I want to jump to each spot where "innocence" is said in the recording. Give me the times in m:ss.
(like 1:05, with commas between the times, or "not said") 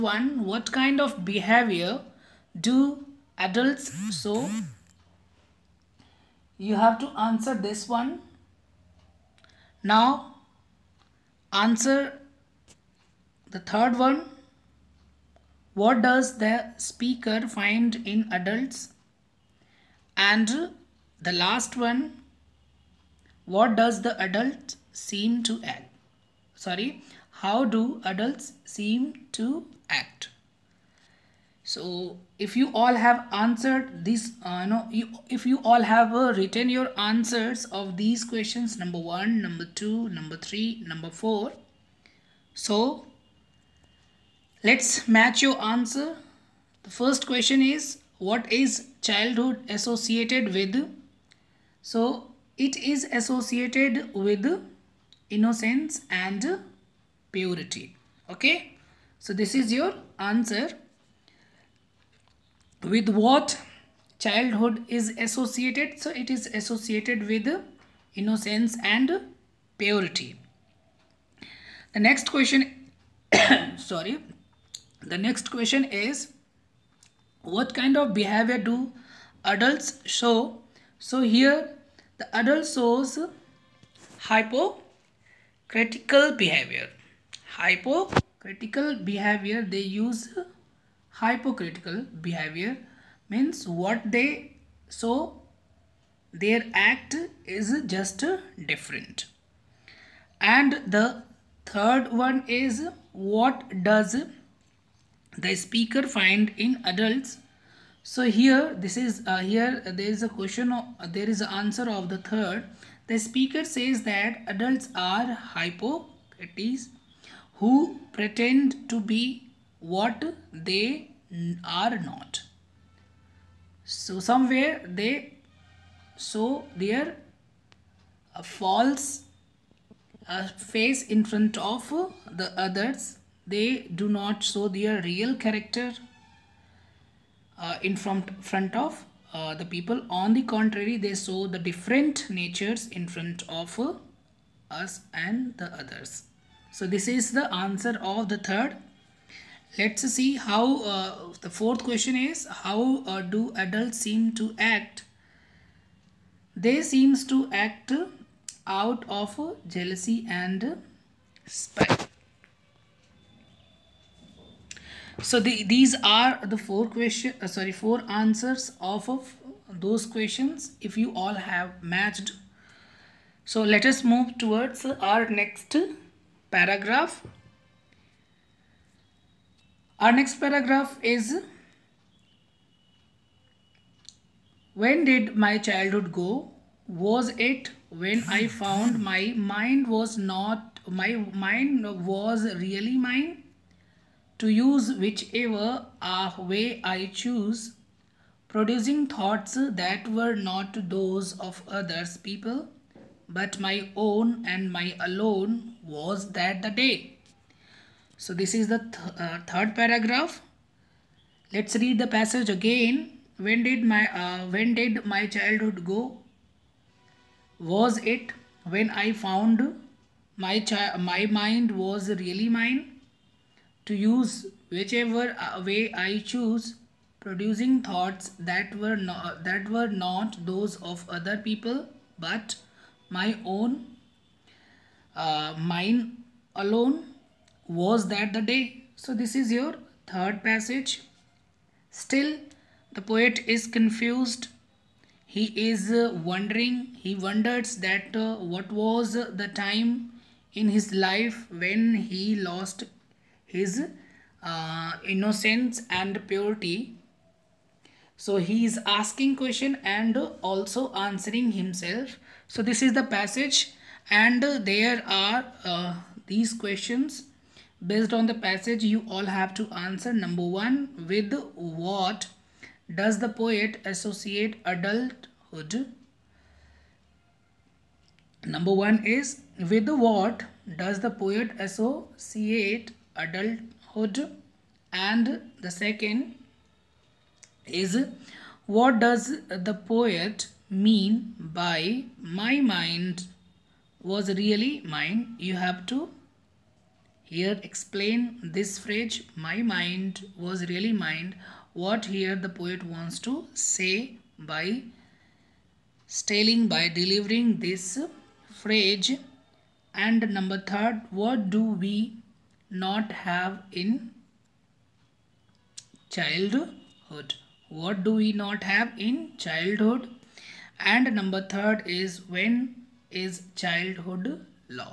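0:55, 1:08, 4:15.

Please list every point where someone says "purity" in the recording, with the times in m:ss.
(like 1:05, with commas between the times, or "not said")
0:57, 1:09, 4:16.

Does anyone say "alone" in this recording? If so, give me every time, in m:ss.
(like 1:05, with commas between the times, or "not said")
3:25, 3:56.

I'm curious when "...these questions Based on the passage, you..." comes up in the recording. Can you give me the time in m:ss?
4:26.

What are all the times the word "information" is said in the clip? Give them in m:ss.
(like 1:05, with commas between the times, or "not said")
not said.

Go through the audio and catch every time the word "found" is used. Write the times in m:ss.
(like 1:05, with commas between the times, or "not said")
3:08, 3:39.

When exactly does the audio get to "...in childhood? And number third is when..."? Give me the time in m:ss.
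5:18.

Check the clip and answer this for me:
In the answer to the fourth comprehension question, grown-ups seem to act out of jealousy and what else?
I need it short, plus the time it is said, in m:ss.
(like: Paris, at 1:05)
spite, at 2:36.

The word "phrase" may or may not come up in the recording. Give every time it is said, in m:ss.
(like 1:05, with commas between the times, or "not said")
4:58, 5:08.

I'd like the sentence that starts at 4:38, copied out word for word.
Number one is with what does the poet associate adulthood?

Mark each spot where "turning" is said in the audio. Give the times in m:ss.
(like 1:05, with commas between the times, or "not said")
not said.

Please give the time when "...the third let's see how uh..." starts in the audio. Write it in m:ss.
2:28.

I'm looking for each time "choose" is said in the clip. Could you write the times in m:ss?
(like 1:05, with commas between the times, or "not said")
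3:17, 3:46.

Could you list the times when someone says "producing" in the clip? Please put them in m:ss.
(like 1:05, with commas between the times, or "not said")
3:18, 3:47.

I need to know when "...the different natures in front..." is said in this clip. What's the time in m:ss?
2:21.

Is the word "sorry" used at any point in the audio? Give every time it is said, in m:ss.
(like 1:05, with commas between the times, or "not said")
0:26, 1:13, 2:47.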